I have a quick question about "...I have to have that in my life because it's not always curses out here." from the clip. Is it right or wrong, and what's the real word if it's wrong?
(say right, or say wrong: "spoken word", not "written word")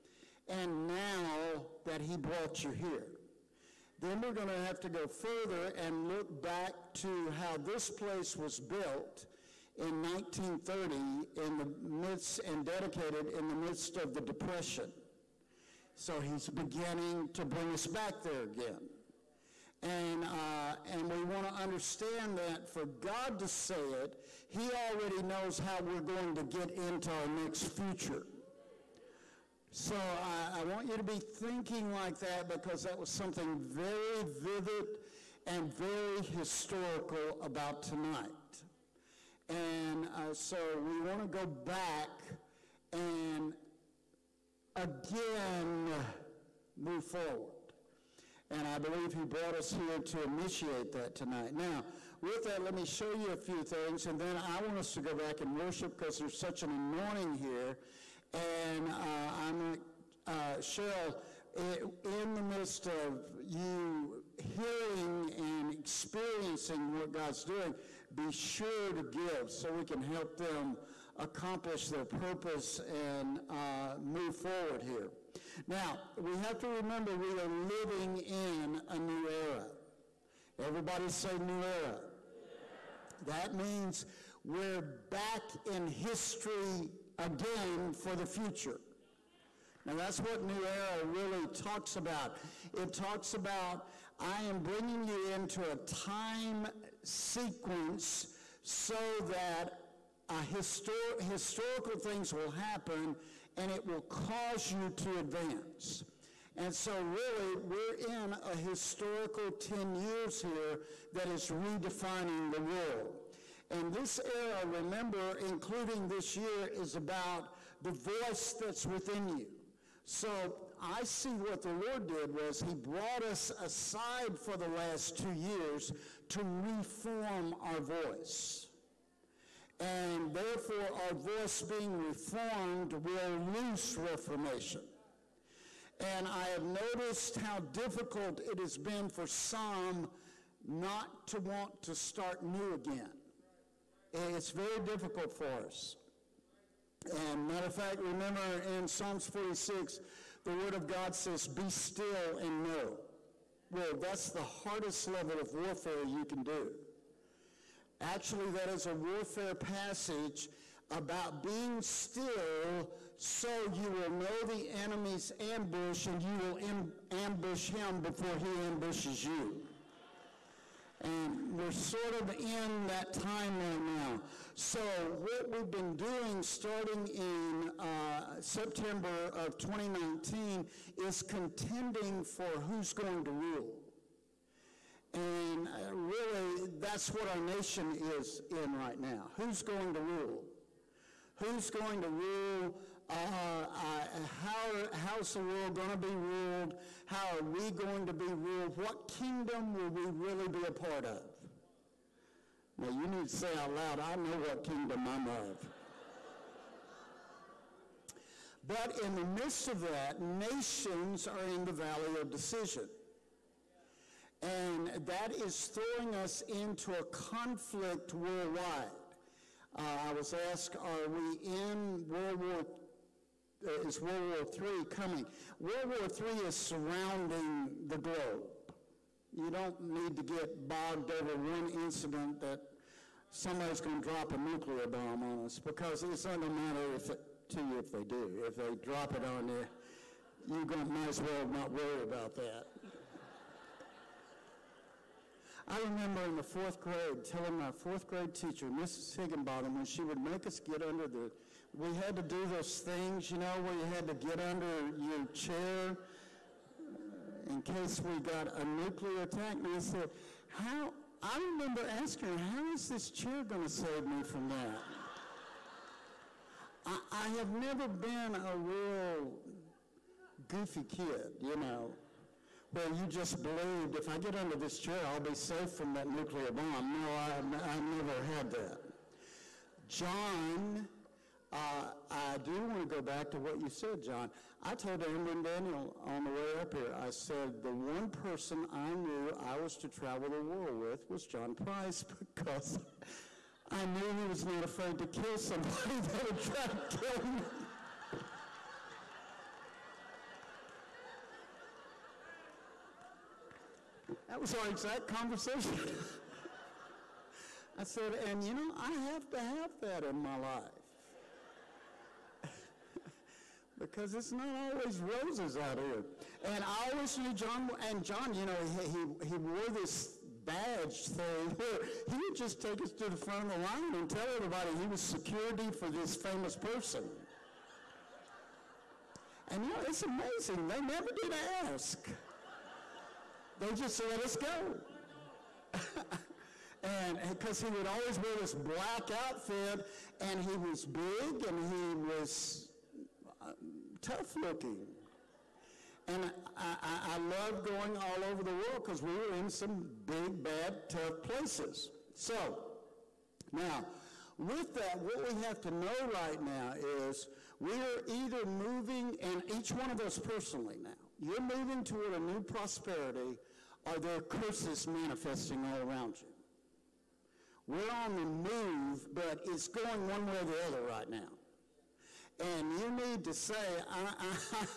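wrong: "roses", not "curses".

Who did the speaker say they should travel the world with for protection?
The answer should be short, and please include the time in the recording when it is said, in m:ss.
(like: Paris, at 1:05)
John Price, at 4:51.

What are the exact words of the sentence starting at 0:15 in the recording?
So he's beginning to bring us back there again.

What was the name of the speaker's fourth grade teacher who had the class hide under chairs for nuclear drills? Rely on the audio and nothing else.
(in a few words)
Mrs. Higginbotham.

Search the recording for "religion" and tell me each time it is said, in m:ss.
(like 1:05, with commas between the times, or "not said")
not said.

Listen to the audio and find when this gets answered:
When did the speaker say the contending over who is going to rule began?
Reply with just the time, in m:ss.
2:58.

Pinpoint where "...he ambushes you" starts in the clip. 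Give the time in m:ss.
2:48.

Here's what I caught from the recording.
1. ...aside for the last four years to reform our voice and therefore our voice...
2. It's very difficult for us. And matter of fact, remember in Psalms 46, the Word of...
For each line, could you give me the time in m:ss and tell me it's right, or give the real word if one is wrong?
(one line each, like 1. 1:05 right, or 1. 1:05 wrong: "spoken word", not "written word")
1. 2:03 wrong: "two", not "four"
2. 2:24 right.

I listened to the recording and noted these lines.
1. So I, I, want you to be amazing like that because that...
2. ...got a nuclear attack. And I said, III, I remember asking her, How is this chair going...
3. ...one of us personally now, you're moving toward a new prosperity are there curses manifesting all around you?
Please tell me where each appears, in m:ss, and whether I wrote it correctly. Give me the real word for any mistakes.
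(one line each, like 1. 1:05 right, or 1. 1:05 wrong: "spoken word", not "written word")
1. 0:29 wrong: "thinking", not "amazing"
2. 4:18 wrong: "How", not "III"
3. 5:59 right.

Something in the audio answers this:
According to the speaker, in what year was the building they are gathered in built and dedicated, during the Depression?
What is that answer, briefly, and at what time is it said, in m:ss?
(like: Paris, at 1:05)
1930, at 0:10.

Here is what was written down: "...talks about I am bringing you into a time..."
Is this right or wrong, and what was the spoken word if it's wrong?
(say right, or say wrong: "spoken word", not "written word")
right.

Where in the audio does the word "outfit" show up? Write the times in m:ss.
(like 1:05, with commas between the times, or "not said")
5:39.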